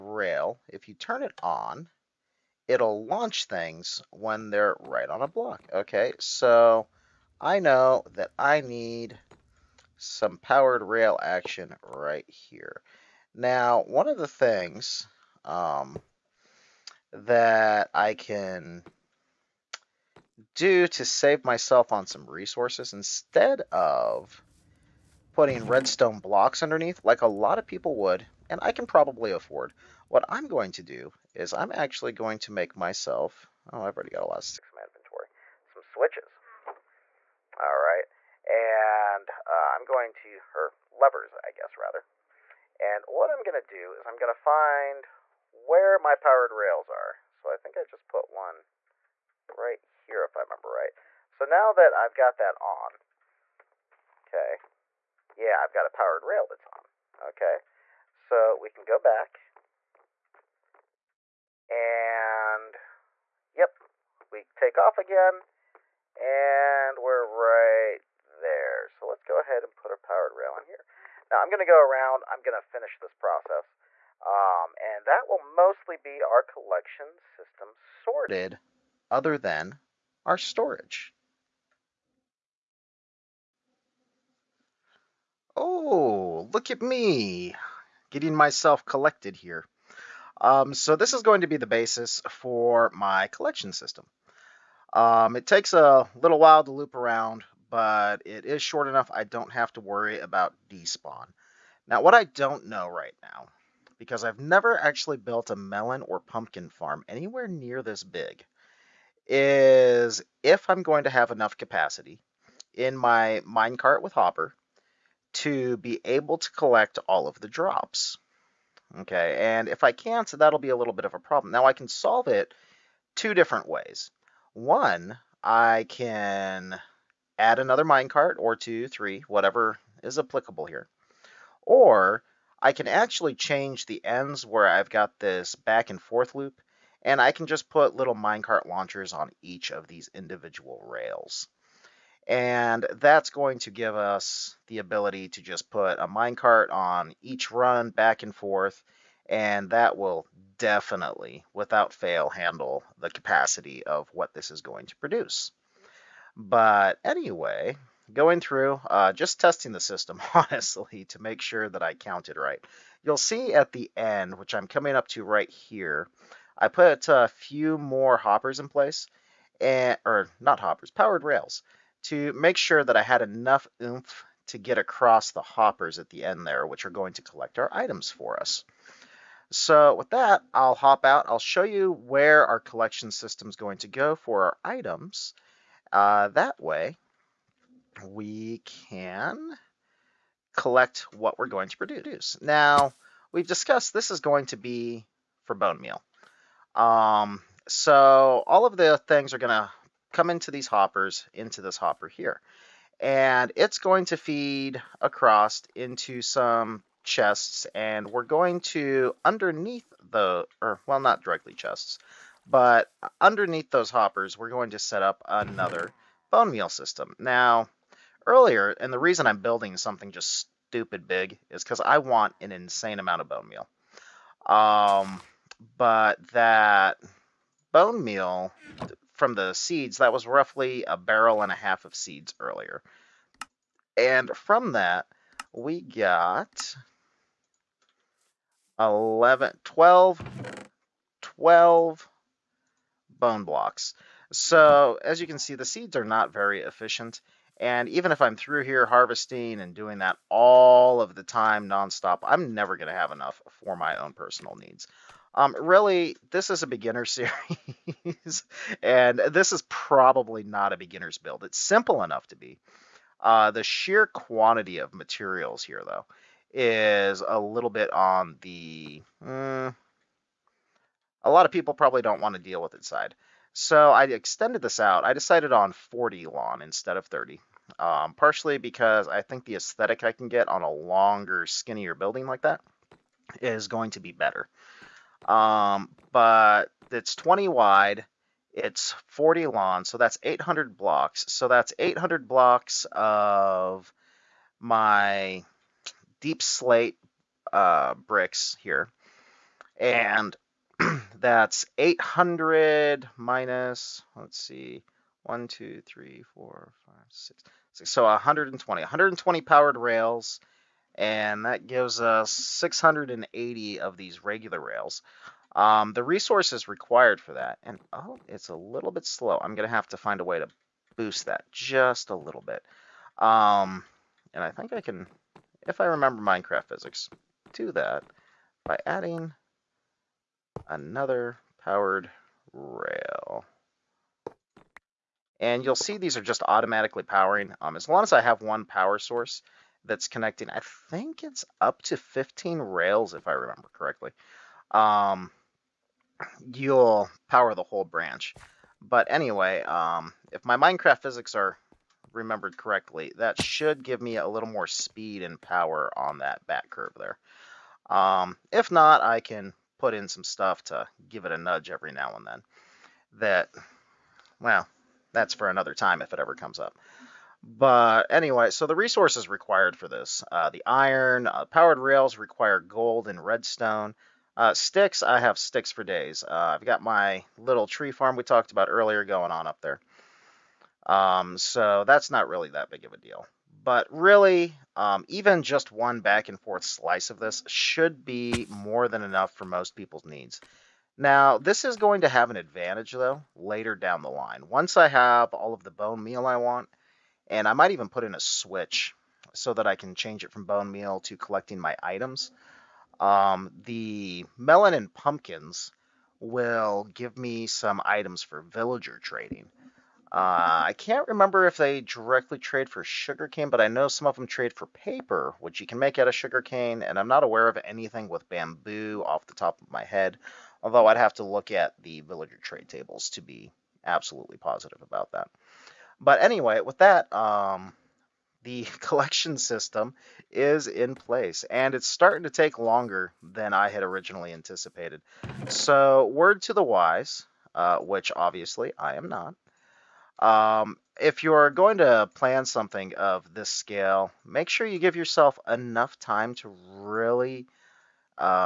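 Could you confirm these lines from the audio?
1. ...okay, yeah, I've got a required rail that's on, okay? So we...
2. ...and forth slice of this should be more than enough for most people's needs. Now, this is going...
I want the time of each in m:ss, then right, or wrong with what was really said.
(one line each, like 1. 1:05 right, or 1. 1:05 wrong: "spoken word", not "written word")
1. 0:54 wrong: "powered", not "required"
2. 6:26 right.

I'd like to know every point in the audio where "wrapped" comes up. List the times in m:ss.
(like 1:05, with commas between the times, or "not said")
not said.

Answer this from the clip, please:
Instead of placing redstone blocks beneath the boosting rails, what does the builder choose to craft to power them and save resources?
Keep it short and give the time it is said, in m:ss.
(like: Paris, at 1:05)
Levers, at 0:40.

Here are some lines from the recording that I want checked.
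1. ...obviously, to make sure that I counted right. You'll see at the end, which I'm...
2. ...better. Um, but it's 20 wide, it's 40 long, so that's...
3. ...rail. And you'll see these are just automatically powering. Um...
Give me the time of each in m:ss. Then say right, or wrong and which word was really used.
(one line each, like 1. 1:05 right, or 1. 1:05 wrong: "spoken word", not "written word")
1. 2:40 wrong: "honestly", not "obviously"
2. 4:44 right
3. 5:32 right.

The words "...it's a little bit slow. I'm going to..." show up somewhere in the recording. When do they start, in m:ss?
5:18.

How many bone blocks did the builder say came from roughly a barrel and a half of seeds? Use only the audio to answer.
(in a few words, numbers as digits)
12.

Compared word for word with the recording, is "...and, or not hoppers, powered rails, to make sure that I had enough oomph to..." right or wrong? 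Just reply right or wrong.
right.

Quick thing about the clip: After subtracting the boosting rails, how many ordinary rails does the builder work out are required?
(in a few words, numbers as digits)
680.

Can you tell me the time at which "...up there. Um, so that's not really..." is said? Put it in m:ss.
6:19.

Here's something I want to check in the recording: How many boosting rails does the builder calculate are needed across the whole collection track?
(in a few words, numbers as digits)
120.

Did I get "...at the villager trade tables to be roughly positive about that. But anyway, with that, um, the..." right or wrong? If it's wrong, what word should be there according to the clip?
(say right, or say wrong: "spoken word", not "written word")
wrong: "absolutely", not "roughly".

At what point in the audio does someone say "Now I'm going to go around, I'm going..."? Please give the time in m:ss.
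1:11.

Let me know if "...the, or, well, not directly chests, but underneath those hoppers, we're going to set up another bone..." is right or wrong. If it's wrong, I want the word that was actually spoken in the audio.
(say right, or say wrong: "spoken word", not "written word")
right.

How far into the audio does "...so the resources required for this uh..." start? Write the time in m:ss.
6:08.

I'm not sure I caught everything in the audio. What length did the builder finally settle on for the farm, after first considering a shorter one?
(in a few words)
40.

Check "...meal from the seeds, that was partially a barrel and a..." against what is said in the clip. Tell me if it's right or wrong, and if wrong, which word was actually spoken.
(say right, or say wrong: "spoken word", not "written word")
wrong: "roughly", not "partially".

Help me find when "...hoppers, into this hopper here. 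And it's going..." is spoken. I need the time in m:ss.
3:20.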